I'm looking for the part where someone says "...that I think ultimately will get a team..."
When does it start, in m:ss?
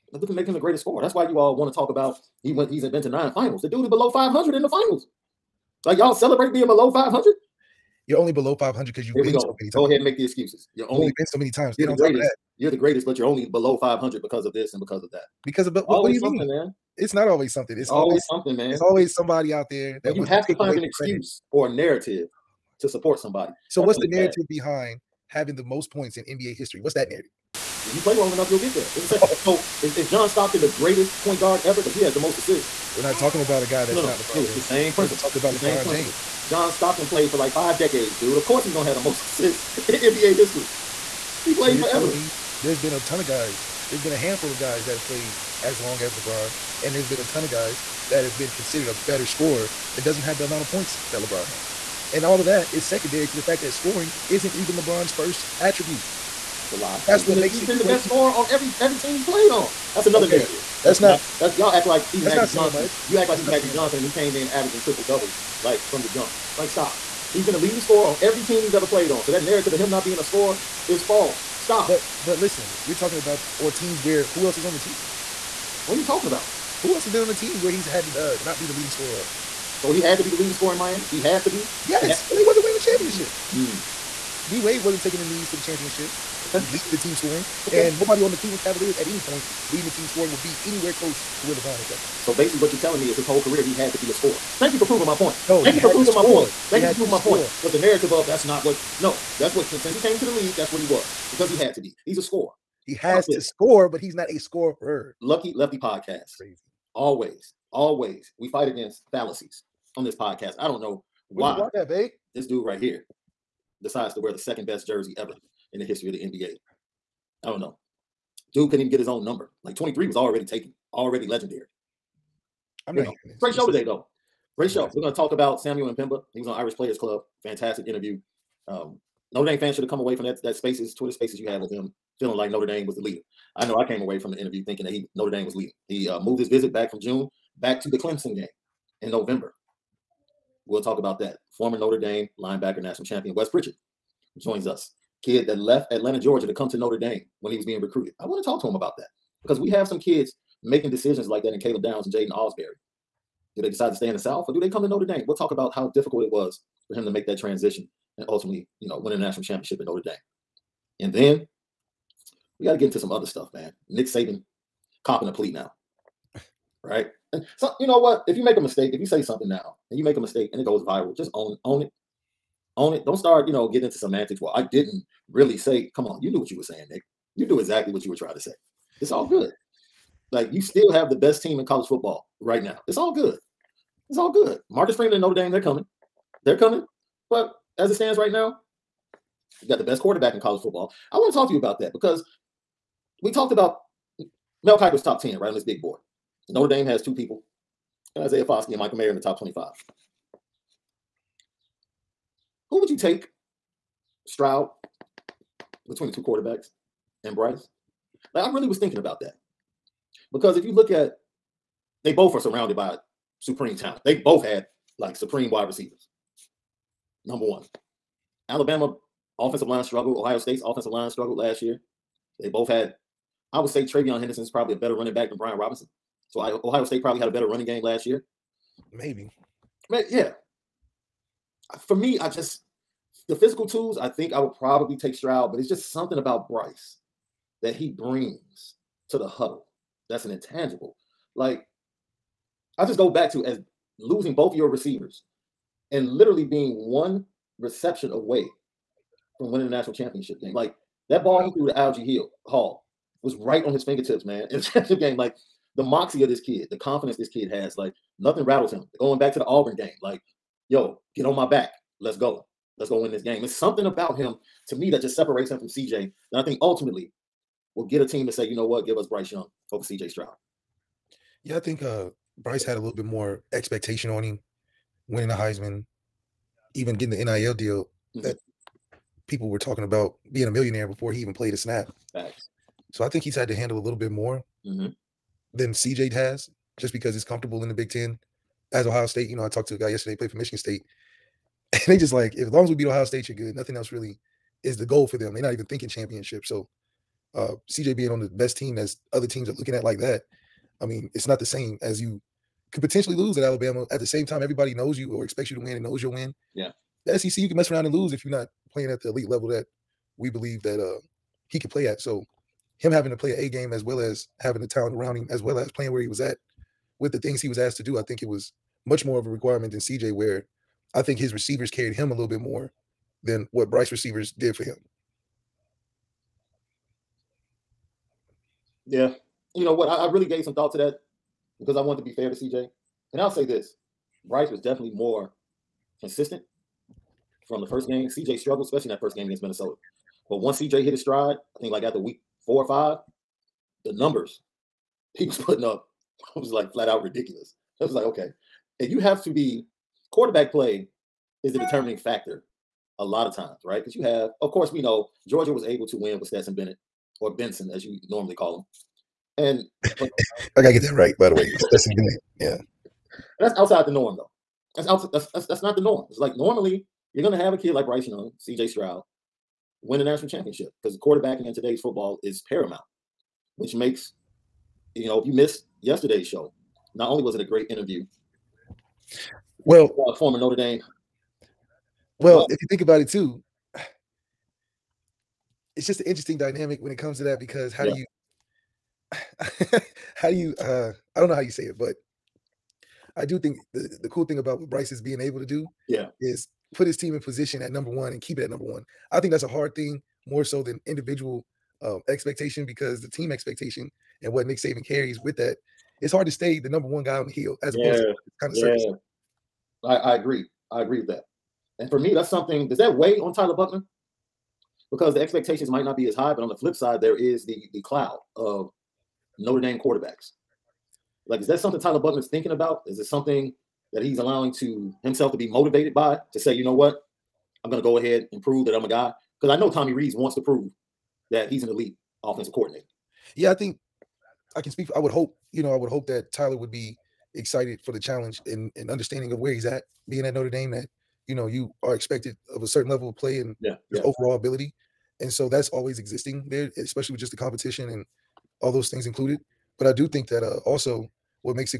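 4:26.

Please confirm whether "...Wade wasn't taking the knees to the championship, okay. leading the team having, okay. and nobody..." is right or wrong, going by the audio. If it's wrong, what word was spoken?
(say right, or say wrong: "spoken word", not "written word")
wrong: "scoring", not "having".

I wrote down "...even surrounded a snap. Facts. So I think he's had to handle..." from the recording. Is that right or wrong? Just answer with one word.
wrong.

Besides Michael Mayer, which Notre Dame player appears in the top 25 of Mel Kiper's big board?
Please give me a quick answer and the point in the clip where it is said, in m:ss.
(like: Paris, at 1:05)
Isaiah Foskey, at 3:18.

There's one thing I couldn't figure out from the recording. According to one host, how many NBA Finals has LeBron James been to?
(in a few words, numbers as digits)
9.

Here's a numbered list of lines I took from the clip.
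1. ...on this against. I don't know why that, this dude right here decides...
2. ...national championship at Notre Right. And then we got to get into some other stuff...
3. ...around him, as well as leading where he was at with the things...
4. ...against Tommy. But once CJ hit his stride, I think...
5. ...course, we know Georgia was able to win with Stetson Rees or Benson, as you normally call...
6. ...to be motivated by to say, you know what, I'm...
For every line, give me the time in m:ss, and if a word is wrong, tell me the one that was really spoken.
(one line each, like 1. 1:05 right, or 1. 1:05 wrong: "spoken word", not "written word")
1. 1:49 wrong: "podcast", not "against"
2. 2:39 wrong: "Dame", not "Right"
3. 5:14 wrong: "playing", not "leading"
4. 5:39 wrong: "Minnesota", not "Tommy"
5. 5:54 wrong: "Bennett", not "Rees"
6. 7:05 right.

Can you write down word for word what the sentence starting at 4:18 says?
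Going back to the Auburn game, like, yo, get on my back.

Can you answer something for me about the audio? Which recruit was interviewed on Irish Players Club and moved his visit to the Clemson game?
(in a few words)
Samuel M'Pemba.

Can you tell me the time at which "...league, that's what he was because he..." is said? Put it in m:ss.
1:40.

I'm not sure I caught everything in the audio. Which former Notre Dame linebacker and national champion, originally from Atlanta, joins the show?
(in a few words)
Wes Pritchett.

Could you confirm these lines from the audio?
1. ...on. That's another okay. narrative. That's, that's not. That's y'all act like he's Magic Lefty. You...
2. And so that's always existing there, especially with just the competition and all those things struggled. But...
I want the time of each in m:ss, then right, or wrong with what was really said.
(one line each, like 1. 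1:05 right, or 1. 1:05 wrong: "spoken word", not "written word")
1. 0:59 wrong: "Johnson", not "Lefty"
2. 7:25 wrong: "included", not "struggled".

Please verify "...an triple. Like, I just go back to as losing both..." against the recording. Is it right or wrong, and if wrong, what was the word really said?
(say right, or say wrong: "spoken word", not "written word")
wrong: "intangible", not "triple".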